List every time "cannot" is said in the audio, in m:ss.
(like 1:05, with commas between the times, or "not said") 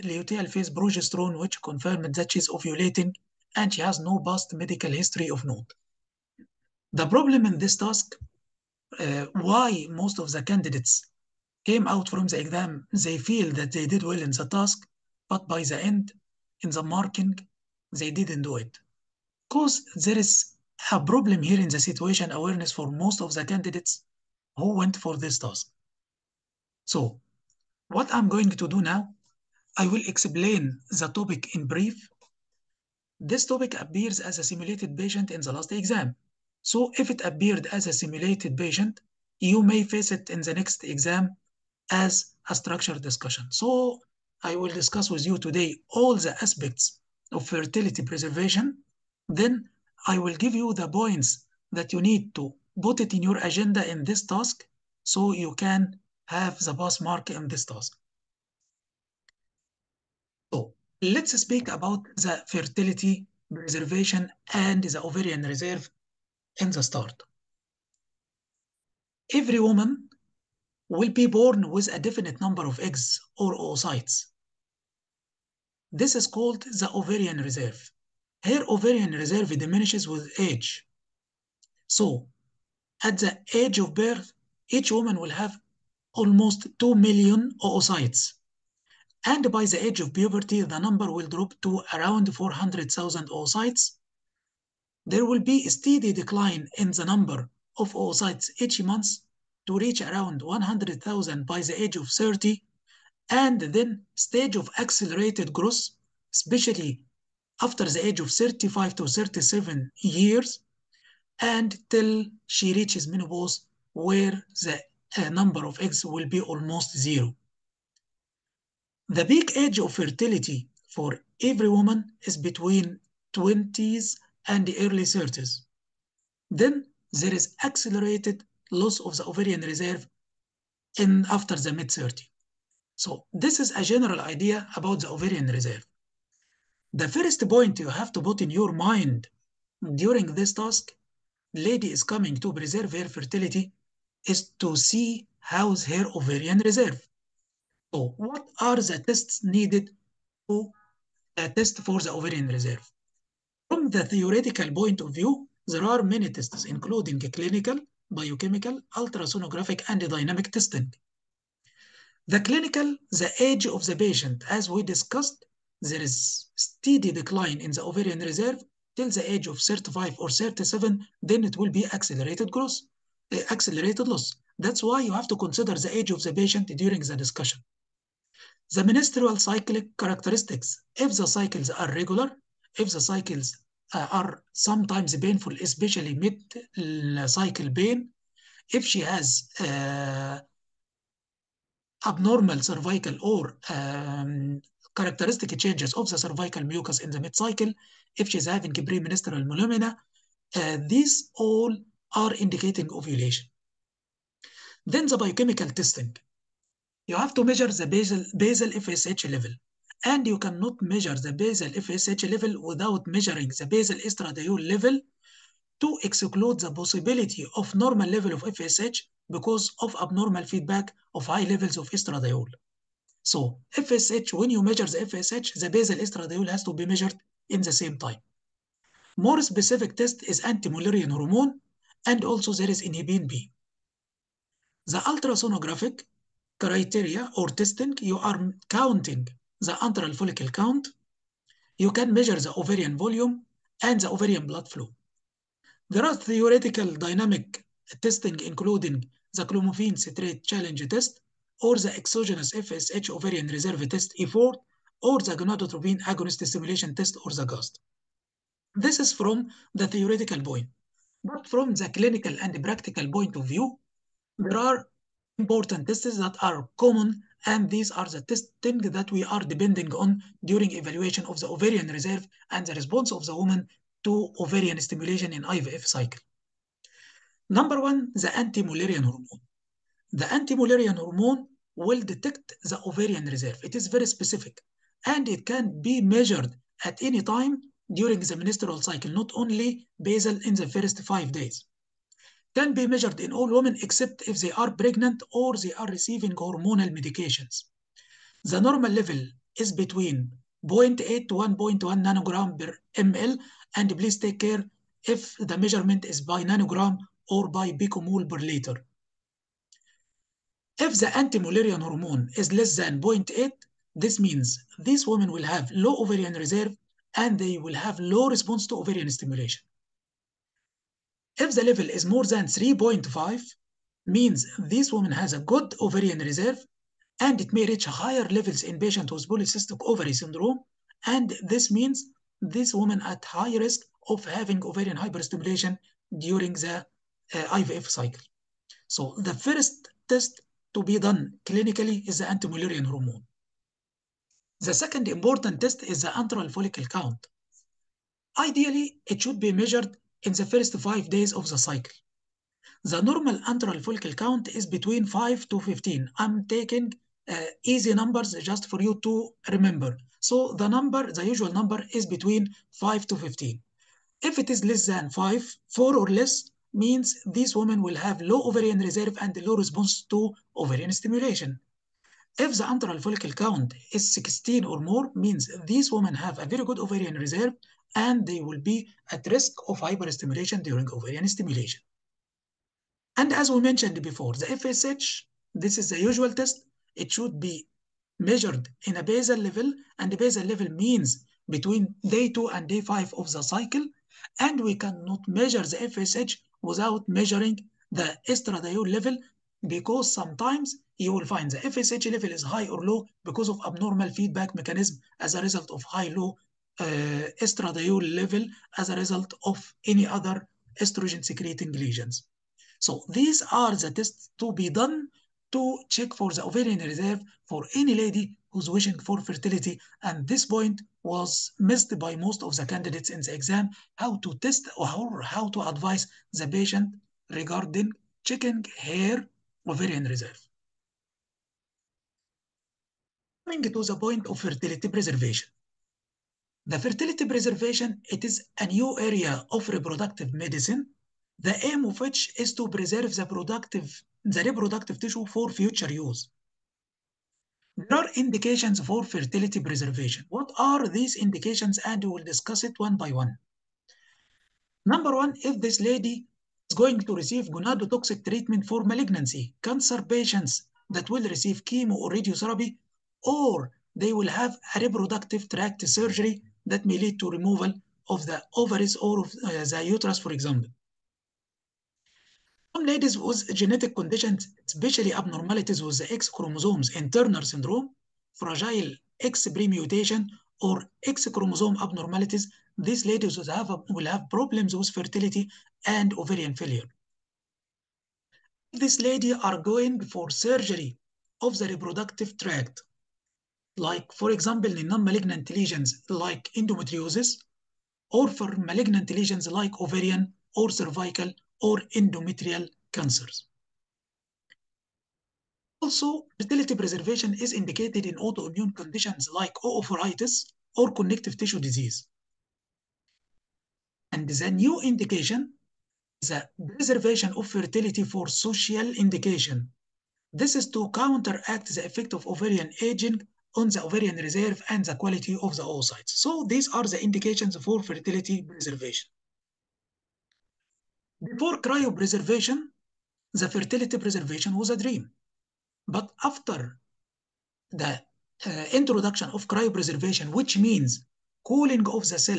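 3:30, 6:34.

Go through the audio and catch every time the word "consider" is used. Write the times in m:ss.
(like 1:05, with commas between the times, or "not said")
2:55.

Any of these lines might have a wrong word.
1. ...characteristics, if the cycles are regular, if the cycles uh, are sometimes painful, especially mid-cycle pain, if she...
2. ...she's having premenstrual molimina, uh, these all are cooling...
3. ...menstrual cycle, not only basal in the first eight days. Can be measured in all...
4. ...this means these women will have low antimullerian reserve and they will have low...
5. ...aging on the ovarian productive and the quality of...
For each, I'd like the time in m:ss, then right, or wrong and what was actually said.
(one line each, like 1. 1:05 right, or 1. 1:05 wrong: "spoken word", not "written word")
1. 2:59 right
2. 3:18 wrong: "indicating", not "cooling"
3. 4:48 wrong: "five", not "eight"
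4. 5:13 wrong: "ovarian", not "antimullerian"
5. 8:42 wrong: "reserve", not "productive".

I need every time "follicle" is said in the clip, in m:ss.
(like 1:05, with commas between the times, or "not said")
4:00, 5:46, 5:53, 6:13.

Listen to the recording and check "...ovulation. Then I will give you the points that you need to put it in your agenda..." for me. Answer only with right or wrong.
wrong.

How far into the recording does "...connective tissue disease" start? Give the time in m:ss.
8:30.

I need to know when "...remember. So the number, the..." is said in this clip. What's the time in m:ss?
5:59.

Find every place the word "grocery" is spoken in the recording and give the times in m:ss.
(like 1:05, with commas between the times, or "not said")
not said.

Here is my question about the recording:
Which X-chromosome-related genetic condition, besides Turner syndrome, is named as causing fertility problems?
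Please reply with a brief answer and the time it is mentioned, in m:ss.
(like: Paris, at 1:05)
Fragile X premutation, at 7:58.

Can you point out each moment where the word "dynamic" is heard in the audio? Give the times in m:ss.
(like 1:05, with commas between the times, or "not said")
2:40, 4:06.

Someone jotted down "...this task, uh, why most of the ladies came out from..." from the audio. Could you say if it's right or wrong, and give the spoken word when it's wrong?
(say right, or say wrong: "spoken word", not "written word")
wrong: "candidates", not "ladies".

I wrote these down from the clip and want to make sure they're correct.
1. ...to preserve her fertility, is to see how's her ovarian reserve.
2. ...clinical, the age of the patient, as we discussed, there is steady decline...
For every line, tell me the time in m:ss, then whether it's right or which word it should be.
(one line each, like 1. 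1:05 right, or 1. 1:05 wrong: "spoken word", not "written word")
1. 2:22 right
2. 2:42 right.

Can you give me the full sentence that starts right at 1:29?
And by the age of puberty, the number will drop to around 400,000 oocytes.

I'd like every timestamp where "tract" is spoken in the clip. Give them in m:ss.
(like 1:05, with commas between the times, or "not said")
7:45, 8:12.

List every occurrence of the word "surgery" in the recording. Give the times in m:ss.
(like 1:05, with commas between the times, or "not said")
7:45, 8:10.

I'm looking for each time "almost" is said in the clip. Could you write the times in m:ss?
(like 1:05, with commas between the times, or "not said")
1:26, 1:56.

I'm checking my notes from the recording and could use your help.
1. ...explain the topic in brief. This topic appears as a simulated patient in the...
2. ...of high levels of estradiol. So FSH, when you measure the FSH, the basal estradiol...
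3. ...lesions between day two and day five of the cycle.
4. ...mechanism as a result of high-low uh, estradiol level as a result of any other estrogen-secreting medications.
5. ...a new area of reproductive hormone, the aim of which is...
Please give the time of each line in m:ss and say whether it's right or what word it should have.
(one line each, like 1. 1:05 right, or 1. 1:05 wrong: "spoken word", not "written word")
1. 0:30 right
2. 3:41 right
3. 6:30 wrong: "means", not "lesions"
4. 6:44 wrong: "lesions", not "medications"
5. 7:18 wrong: "medicine", not "hormone".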